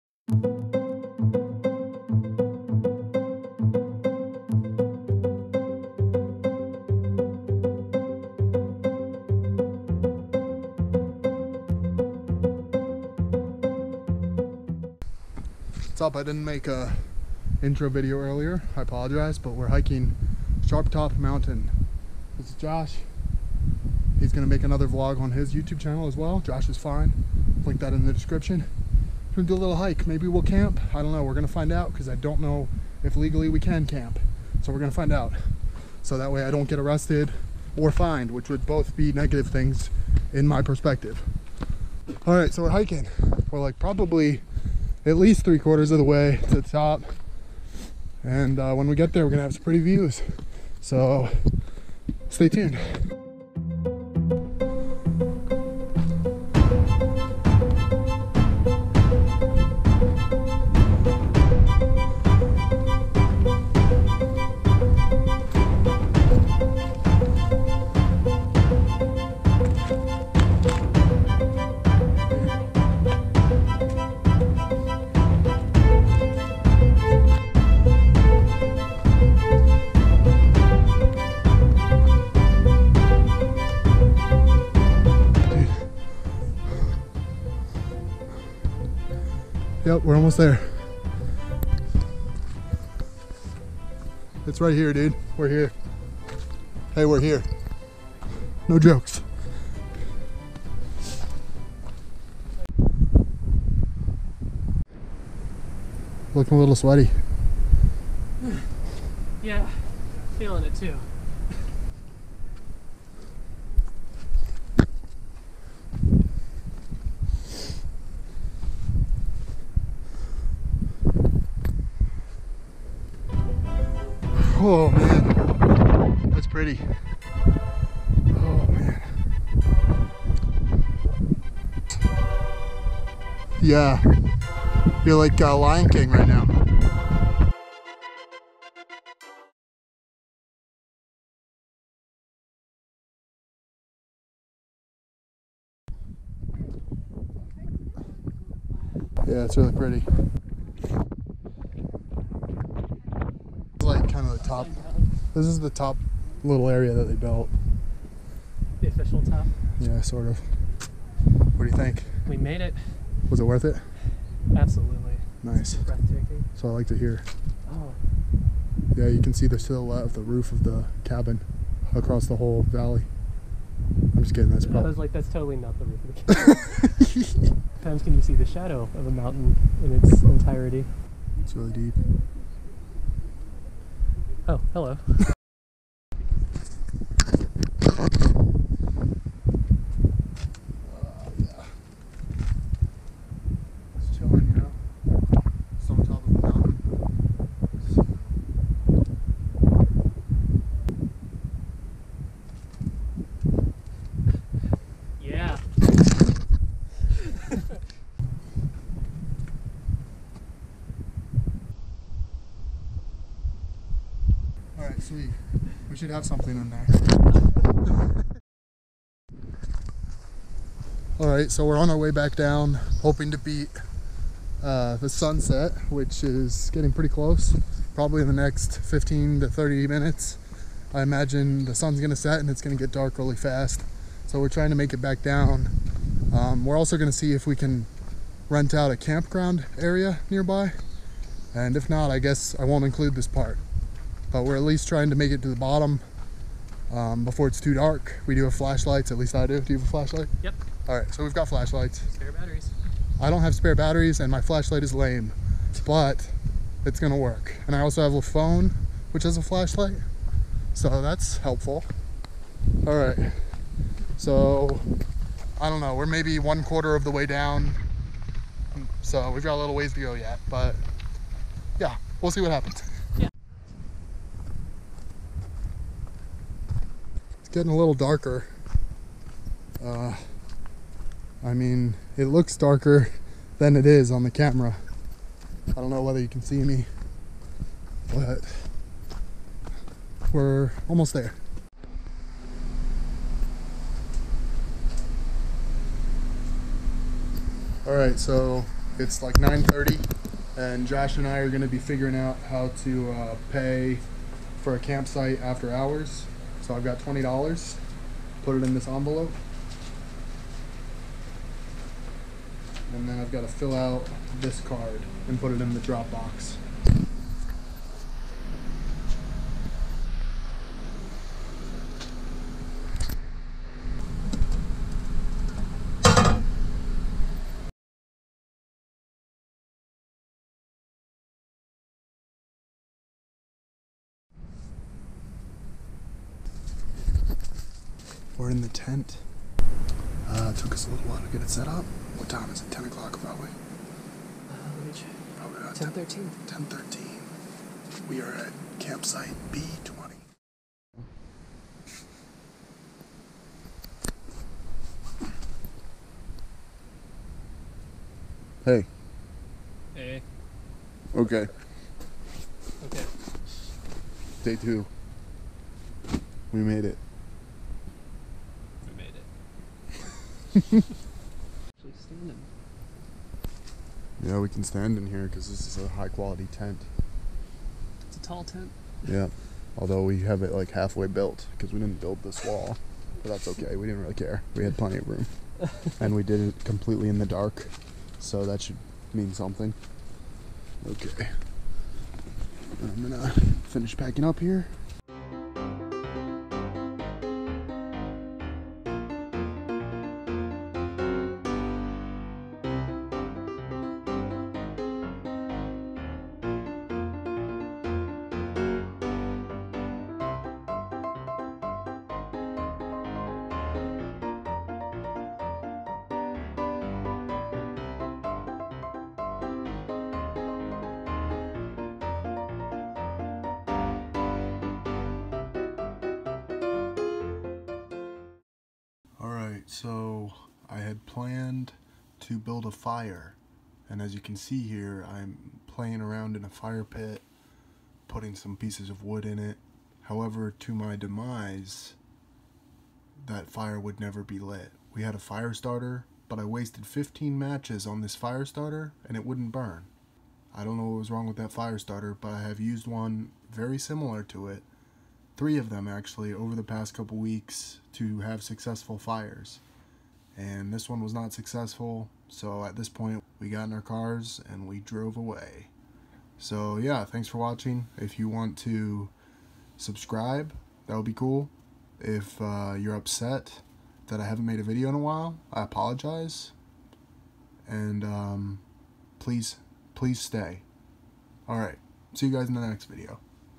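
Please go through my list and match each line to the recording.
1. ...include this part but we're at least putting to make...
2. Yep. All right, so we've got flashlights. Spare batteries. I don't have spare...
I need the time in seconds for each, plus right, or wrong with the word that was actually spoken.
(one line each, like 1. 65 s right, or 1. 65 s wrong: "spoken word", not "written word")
1. 242 s wrong: "trying", not "putting"
2. 250 s right.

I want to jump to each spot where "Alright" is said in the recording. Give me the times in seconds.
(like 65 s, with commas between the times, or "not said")
429 s, 481 s.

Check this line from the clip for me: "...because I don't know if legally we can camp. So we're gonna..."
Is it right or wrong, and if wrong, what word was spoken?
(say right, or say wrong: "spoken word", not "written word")
right.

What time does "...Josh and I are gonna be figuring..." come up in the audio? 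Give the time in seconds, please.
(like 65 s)
300 s.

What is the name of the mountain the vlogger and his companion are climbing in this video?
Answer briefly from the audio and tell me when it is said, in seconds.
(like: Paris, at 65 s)
Sharp Top Mountain, at 20 s.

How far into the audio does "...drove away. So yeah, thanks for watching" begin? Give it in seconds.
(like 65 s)
464 s.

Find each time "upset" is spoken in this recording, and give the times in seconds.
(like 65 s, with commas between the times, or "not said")
472 s.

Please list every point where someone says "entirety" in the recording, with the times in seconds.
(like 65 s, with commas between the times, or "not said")
180 s.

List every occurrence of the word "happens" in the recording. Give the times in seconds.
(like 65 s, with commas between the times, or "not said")
272 s.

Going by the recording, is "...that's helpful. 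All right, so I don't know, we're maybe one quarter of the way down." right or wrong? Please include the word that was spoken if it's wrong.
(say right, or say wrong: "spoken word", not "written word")
right.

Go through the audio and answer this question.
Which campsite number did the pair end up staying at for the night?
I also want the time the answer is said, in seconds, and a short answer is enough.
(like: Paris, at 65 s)
B20, at 349 s.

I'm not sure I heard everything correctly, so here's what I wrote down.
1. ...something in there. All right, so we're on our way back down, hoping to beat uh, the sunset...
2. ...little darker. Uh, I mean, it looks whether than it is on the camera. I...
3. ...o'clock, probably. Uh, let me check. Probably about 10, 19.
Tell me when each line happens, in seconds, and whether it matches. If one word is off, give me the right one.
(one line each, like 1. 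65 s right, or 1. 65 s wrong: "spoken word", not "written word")
1. 216 s right
2. 277 s wrong: "darker", not "whether"
3. 342 s wrong: "13", not "19".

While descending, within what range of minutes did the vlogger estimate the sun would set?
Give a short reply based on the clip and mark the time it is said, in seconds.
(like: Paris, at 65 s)
15 to 30 minutes, at 228 s.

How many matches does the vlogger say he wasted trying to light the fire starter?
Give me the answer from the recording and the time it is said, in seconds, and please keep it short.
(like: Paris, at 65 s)
15, at 446 s.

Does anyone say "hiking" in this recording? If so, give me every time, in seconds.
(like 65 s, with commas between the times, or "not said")
19 s, 42 s.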